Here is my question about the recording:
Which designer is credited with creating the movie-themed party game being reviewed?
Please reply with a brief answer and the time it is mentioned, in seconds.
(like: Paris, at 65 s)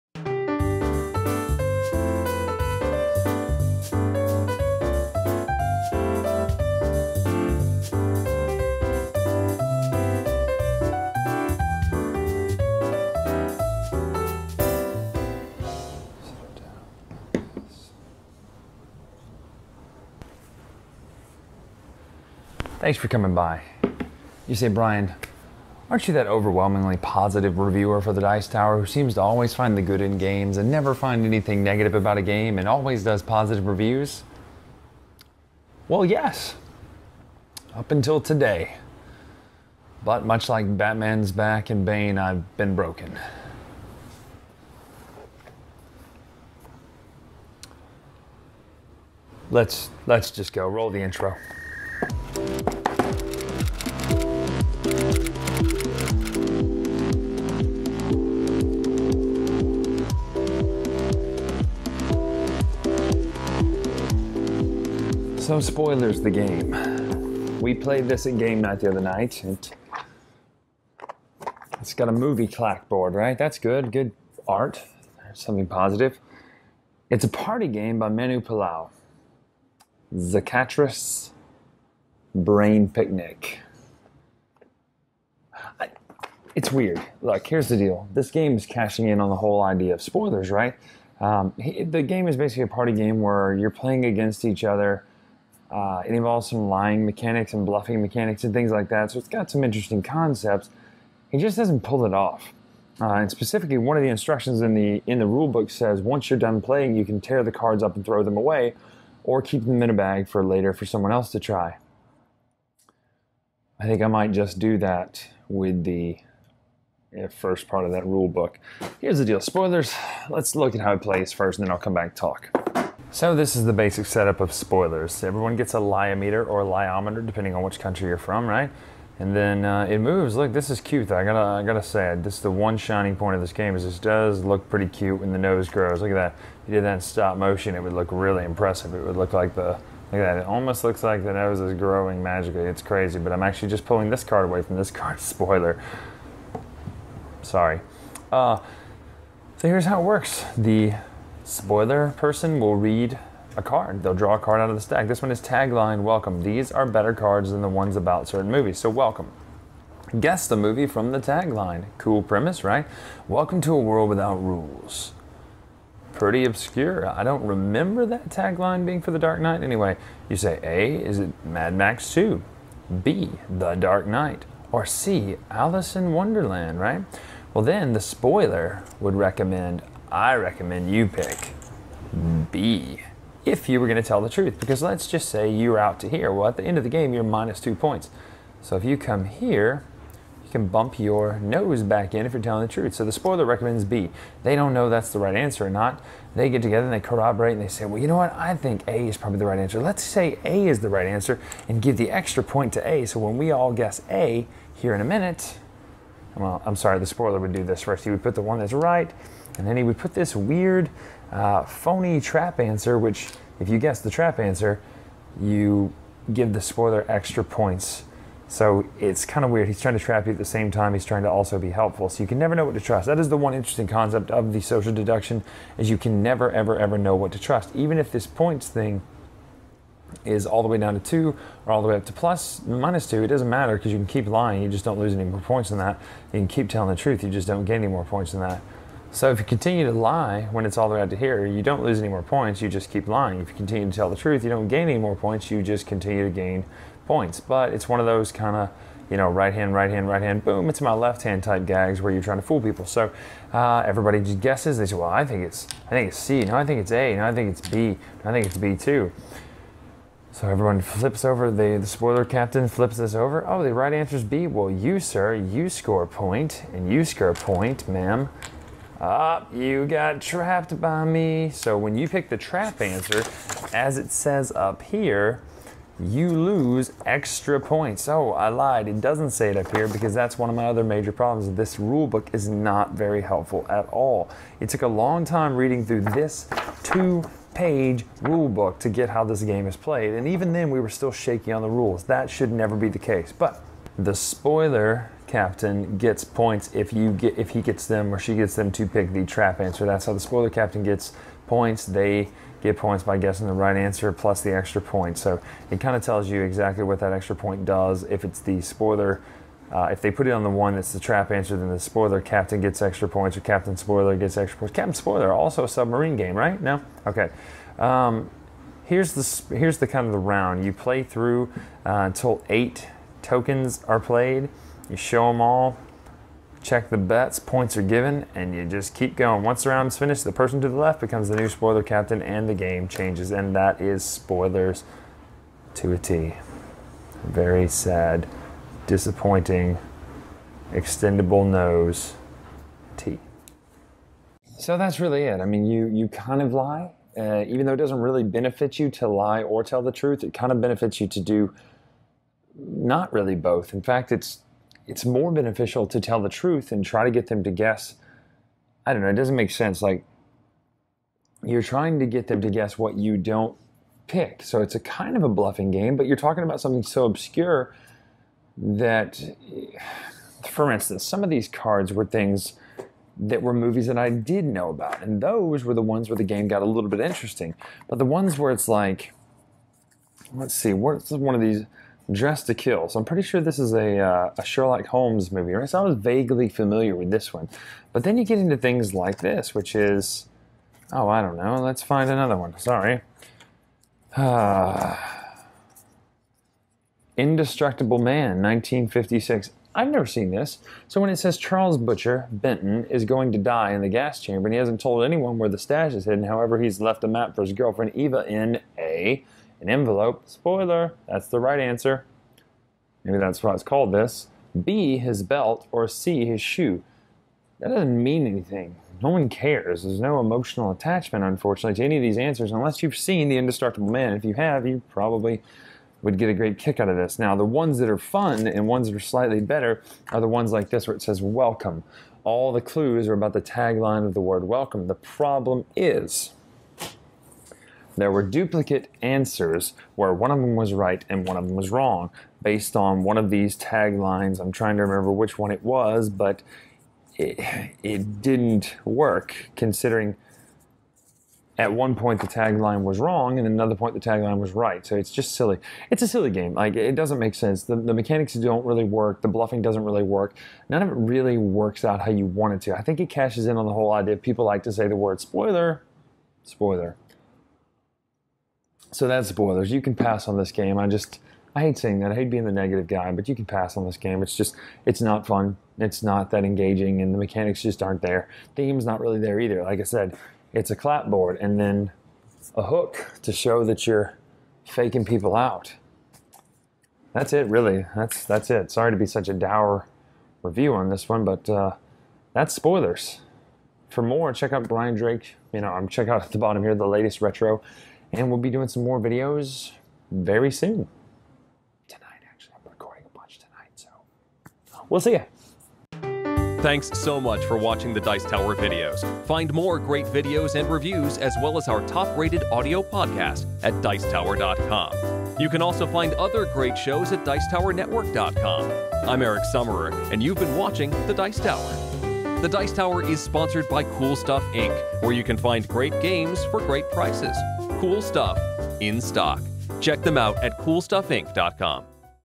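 Manu Palau, at 78 s.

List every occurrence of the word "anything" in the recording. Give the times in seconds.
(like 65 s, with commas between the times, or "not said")
31 s, 418 s.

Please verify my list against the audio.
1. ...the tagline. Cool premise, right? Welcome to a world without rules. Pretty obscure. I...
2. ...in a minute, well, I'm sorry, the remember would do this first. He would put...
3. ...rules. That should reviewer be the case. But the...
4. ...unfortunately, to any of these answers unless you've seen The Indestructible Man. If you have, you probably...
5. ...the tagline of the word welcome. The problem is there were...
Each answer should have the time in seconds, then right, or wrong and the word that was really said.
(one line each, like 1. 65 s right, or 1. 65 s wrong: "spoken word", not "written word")
1. 161 s right
2. 204 s wrong: "spoiler", not "remember"
3. 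291 s wrong: "never", not "reviewer"
4. 421 s right
5. 433 s right.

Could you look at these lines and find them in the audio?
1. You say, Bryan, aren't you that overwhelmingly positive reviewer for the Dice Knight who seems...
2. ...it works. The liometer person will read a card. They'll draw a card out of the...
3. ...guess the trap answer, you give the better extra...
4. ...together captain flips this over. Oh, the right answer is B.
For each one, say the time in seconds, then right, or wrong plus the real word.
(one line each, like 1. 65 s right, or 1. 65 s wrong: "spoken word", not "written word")
1. 24 s wrong: "Tower", not "Knight"
2. 150 s wrong: "spoiler", not "liometer"
3. 213 s wrong: "spoiler", not "better"
4. 261 s wrong: "spoiler", not "together".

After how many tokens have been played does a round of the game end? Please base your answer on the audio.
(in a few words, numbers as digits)
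8.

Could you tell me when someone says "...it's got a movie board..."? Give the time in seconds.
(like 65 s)
71 s.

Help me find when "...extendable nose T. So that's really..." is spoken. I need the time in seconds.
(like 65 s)
340 s.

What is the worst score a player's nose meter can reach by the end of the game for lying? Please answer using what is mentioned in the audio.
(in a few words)
-2.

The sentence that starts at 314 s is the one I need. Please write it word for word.
Captain spoiler also a submarine game, right?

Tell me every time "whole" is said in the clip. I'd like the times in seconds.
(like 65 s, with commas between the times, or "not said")
89 s, 463 s.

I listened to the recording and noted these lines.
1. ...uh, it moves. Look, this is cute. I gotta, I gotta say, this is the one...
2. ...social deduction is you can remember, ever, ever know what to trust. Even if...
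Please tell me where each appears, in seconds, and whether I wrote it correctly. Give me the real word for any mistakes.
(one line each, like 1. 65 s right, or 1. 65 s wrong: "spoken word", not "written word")
1. 129 s right
2. 224 s wrong: "never", not "remember".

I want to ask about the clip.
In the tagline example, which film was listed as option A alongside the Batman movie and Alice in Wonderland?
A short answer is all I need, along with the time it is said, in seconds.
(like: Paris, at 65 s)
Mad Max 2, at 171 s.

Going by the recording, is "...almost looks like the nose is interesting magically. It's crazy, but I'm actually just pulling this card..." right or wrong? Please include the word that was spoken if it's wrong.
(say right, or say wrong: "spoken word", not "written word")
wrong: "growing", not "interesting".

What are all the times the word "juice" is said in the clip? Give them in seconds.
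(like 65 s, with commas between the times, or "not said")
not said.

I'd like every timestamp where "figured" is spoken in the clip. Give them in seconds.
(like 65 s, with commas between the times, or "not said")
not said.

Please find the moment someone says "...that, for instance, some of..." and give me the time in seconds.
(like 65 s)
368 s.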